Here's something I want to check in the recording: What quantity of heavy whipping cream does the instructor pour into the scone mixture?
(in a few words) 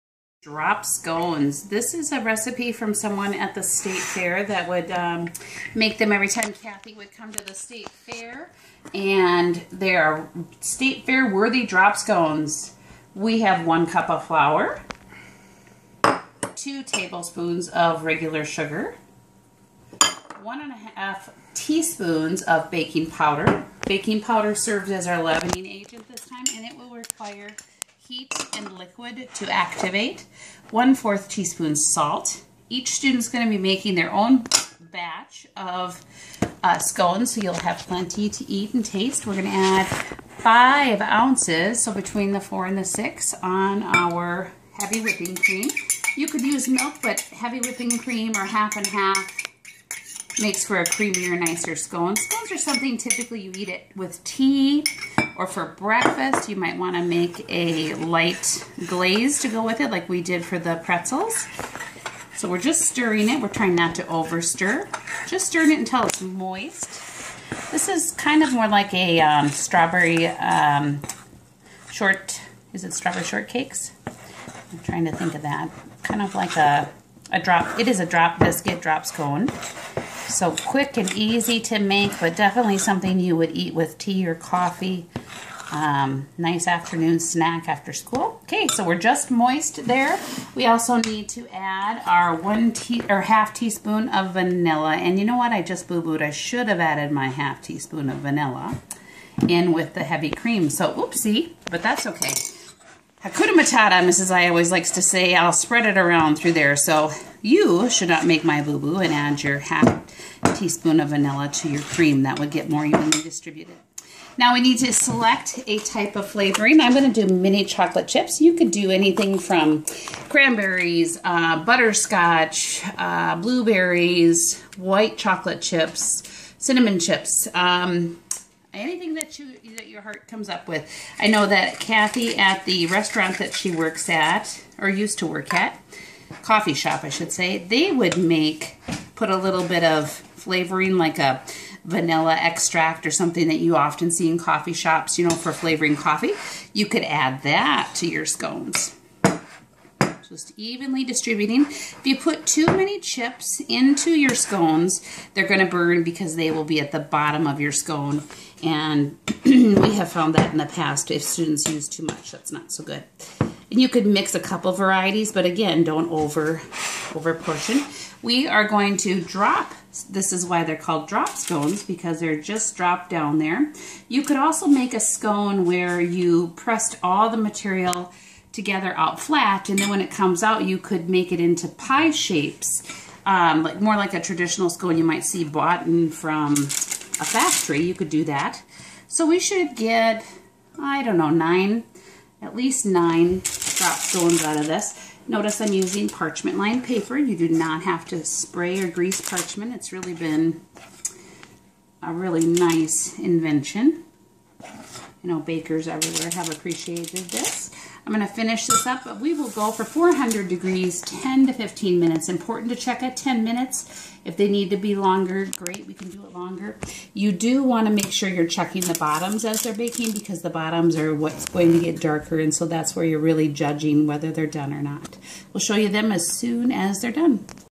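5 ounces.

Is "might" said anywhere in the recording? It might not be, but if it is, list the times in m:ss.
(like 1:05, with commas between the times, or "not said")
0:56, 3:05.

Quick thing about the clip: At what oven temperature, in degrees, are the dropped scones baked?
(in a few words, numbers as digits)
400 degrees.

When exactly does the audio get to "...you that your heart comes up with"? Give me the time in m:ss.
2:09.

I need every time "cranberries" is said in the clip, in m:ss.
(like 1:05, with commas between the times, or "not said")
2:00.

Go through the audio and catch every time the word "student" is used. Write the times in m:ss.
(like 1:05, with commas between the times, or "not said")
0:32, 2:41.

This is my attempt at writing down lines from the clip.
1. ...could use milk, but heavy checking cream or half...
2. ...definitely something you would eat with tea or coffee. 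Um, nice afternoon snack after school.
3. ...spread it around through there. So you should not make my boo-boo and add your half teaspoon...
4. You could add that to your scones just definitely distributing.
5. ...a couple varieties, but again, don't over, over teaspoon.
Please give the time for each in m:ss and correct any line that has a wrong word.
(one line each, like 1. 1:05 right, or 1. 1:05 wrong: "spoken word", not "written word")
1. 0:46 wrong: "whipping", not "checking"
2. 1:22 right
3. 1:45 right
4. 2:26 wrong: "evenly", not "definitely"
5. 2:44 wrong: "portion", not "teaspoon".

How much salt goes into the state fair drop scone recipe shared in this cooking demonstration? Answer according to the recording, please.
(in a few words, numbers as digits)
1/4 teaspoon.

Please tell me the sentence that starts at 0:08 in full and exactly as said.
And they are state fair worthy drop scones.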